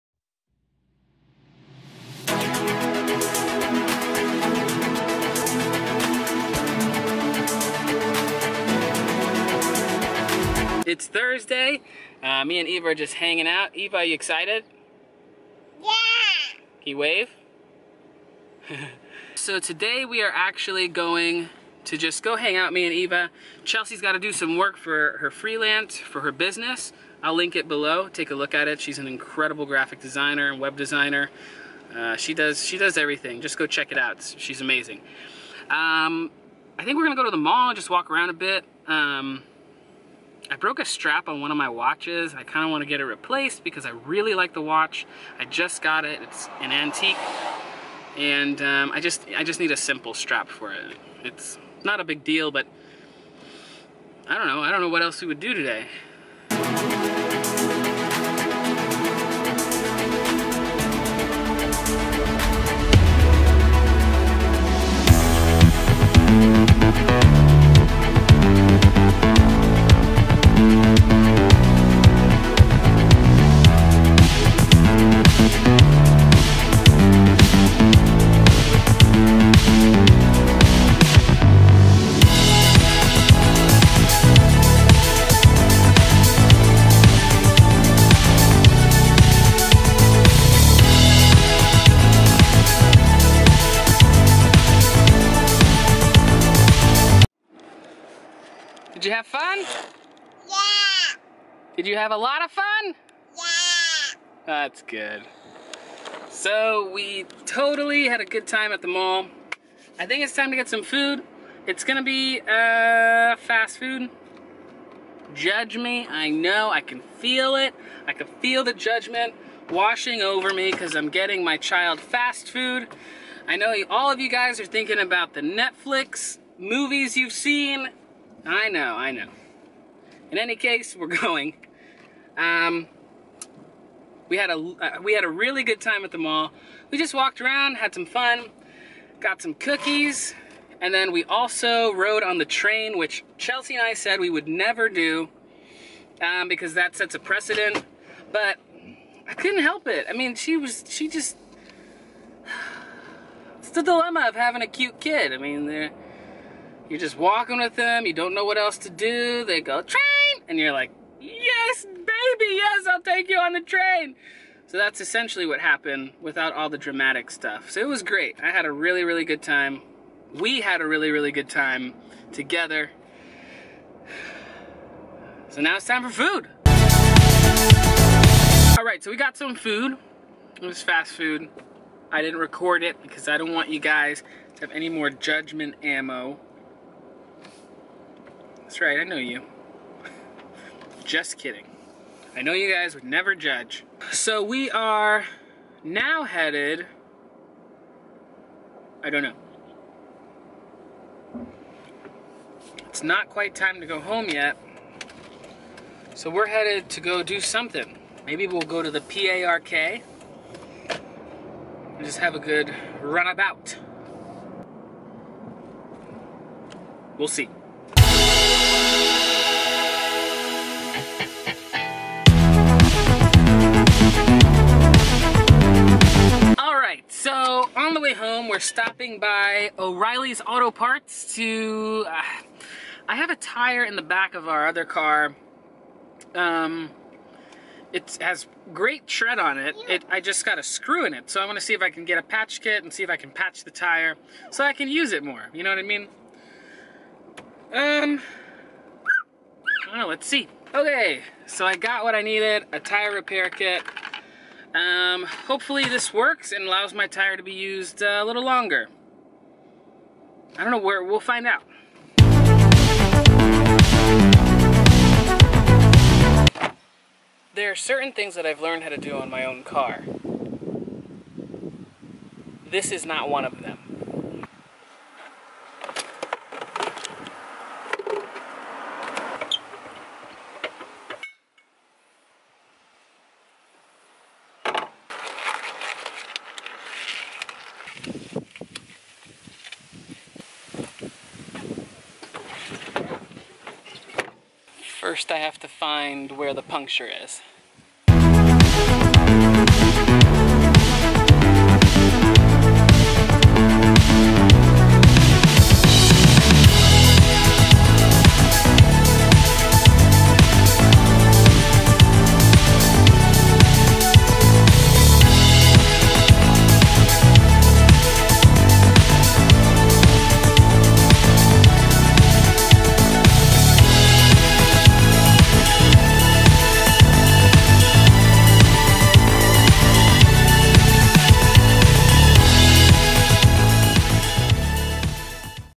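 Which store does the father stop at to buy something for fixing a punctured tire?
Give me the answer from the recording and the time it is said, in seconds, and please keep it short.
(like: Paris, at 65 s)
O'Reilly's Auto Parts, at 229 s.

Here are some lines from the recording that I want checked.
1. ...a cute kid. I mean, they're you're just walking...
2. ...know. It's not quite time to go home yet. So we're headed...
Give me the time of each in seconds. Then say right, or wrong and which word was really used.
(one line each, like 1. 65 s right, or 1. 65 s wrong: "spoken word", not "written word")
1. 154 s right
2. 199 s right.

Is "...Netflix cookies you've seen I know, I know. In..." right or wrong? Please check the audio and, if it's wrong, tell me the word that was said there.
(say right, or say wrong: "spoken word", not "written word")
wrong: "movies", not "cookies".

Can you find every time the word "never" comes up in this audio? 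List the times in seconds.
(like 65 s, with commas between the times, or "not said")
144 s, 193 s.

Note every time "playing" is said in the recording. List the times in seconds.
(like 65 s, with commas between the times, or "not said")
not said.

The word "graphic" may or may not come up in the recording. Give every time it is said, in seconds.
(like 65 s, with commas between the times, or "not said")
29 s.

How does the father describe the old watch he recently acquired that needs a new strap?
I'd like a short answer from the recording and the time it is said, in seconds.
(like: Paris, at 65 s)
An antique, at 46 s.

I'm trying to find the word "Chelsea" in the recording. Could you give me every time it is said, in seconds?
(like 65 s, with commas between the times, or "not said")
23 s, 143 s.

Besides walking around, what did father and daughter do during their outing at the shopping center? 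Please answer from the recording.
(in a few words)
Cookies.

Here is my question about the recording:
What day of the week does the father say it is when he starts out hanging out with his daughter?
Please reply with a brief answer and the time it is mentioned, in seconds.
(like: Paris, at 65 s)
Thursday, at 11 s.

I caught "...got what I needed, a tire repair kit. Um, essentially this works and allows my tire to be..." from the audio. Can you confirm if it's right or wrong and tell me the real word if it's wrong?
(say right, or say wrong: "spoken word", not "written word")
wrong: "hopefully", not "essentially".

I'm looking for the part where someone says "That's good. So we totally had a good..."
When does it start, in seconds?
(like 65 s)
104 s.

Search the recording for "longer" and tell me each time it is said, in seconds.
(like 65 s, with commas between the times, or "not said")
258 s.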